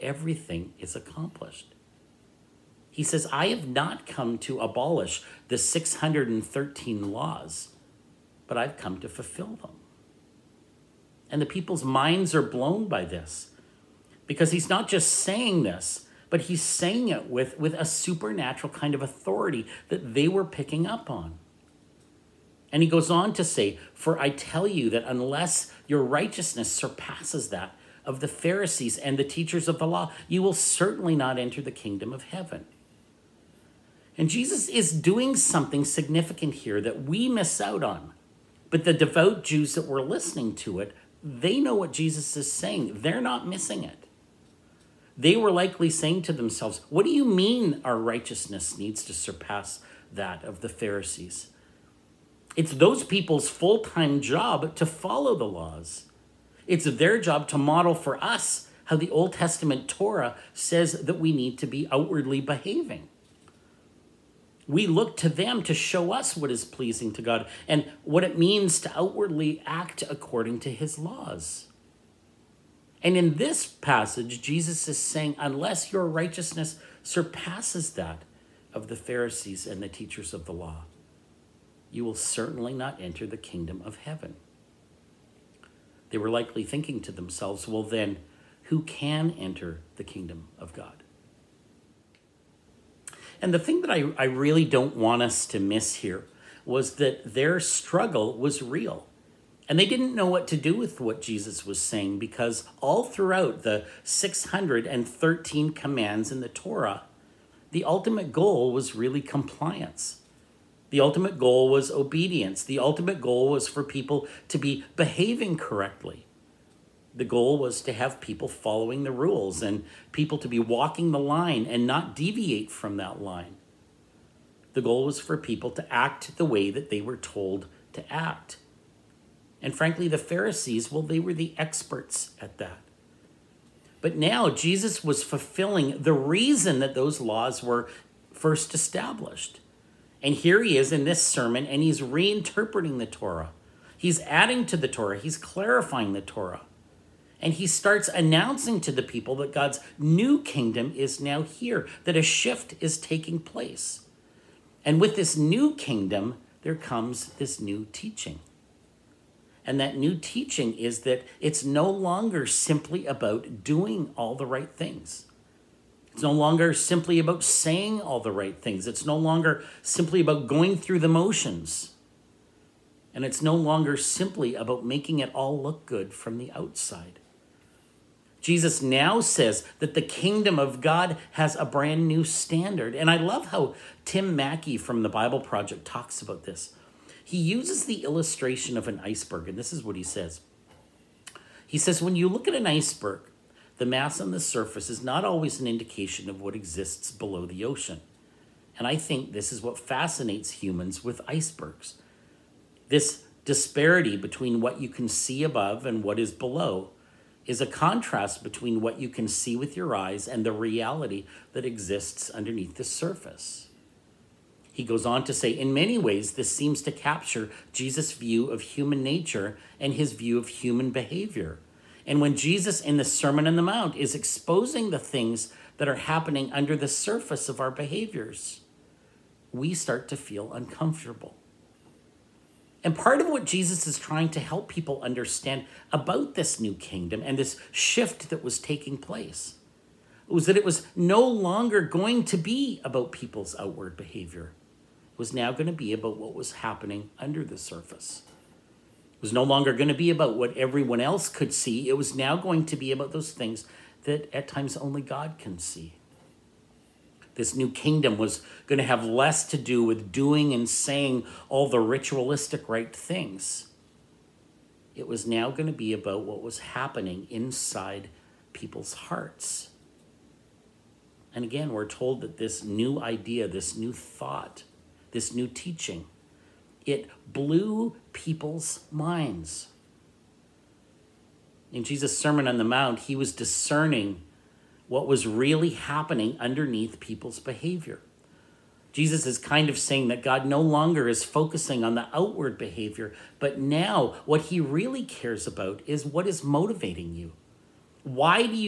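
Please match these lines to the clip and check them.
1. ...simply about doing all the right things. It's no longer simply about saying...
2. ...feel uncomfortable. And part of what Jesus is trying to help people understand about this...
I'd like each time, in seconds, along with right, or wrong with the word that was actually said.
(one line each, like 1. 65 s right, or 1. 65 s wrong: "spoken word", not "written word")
1. 162 s right
2. 230 s right.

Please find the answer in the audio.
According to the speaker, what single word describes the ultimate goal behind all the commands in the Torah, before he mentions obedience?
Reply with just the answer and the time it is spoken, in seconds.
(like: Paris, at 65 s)
Compliance, at 109 s.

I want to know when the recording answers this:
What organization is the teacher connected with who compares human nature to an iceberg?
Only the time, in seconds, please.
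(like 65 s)
185 s.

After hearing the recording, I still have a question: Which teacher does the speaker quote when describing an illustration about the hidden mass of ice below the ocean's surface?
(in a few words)
Tim Mackie.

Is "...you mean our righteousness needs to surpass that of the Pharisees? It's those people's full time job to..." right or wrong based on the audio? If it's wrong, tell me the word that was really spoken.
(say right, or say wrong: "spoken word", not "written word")
right.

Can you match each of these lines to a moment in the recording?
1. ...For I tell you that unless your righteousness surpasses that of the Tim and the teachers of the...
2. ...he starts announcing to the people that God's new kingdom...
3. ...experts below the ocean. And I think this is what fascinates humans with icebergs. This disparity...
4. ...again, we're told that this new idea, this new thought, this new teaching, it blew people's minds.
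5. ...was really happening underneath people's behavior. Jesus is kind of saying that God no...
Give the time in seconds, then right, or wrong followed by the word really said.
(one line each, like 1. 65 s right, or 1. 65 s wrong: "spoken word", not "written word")
1. 23 s wrong: "Pharisees", not "Tim"
2. 147 s right
3. 196 s wrong: "exists", not "experts"
4. 271 s right
5. 285 s right.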